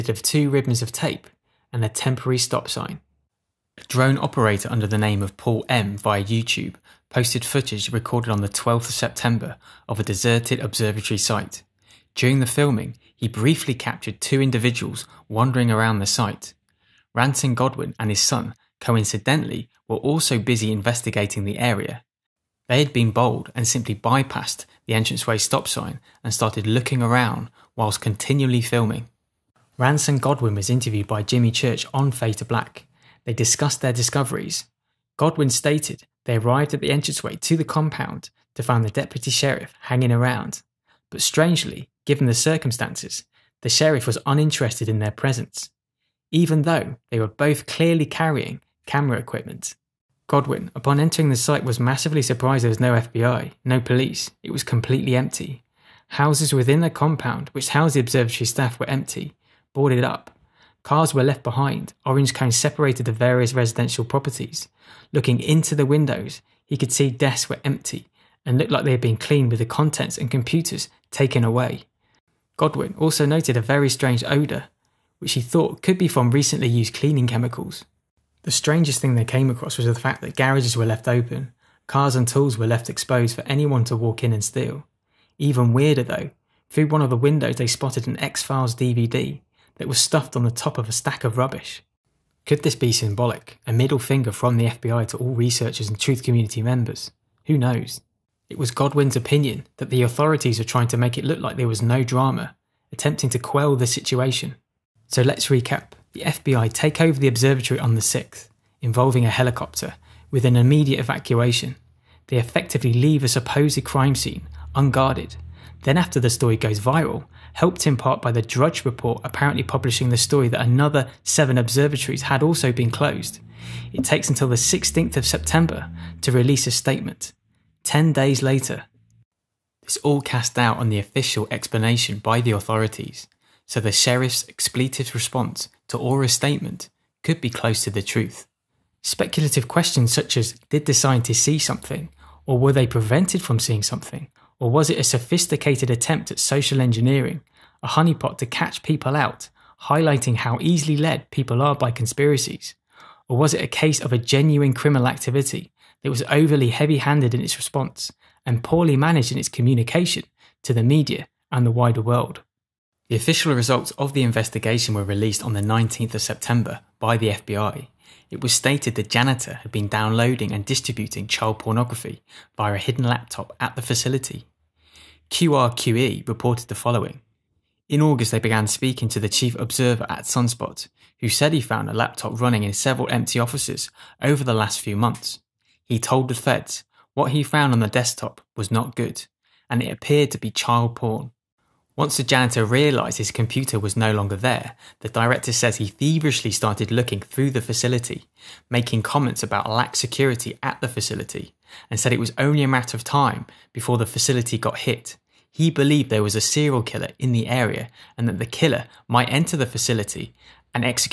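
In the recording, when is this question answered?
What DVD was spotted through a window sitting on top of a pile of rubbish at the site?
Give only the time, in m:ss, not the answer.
1:28.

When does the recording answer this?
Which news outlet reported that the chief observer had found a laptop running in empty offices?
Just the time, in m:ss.
2:55.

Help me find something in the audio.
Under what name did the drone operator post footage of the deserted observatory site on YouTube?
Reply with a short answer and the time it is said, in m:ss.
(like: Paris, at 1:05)
Paul M, at 0:05.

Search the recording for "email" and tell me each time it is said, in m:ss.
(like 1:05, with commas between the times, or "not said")
not said.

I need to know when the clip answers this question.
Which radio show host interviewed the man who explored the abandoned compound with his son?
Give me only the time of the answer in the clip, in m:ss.
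0:31.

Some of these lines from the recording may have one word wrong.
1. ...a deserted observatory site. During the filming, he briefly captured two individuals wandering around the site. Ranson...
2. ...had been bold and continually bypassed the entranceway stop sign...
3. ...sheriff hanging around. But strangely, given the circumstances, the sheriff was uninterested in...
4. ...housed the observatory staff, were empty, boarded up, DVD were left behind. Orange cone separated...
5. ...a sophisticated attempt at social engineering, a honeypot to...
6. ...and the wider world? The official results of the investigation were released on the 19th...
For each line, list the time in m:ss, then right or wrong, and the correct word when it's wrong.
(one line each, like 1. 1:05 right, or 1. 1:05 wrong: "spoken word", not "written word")
1. 0:09 right
2. 0:22 wrong: "simply", not "continually"
3. 0:39 right
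4. 0:57 wrong: "Cars", not "DVD"
5. 2:24 right
6. 2:41 right.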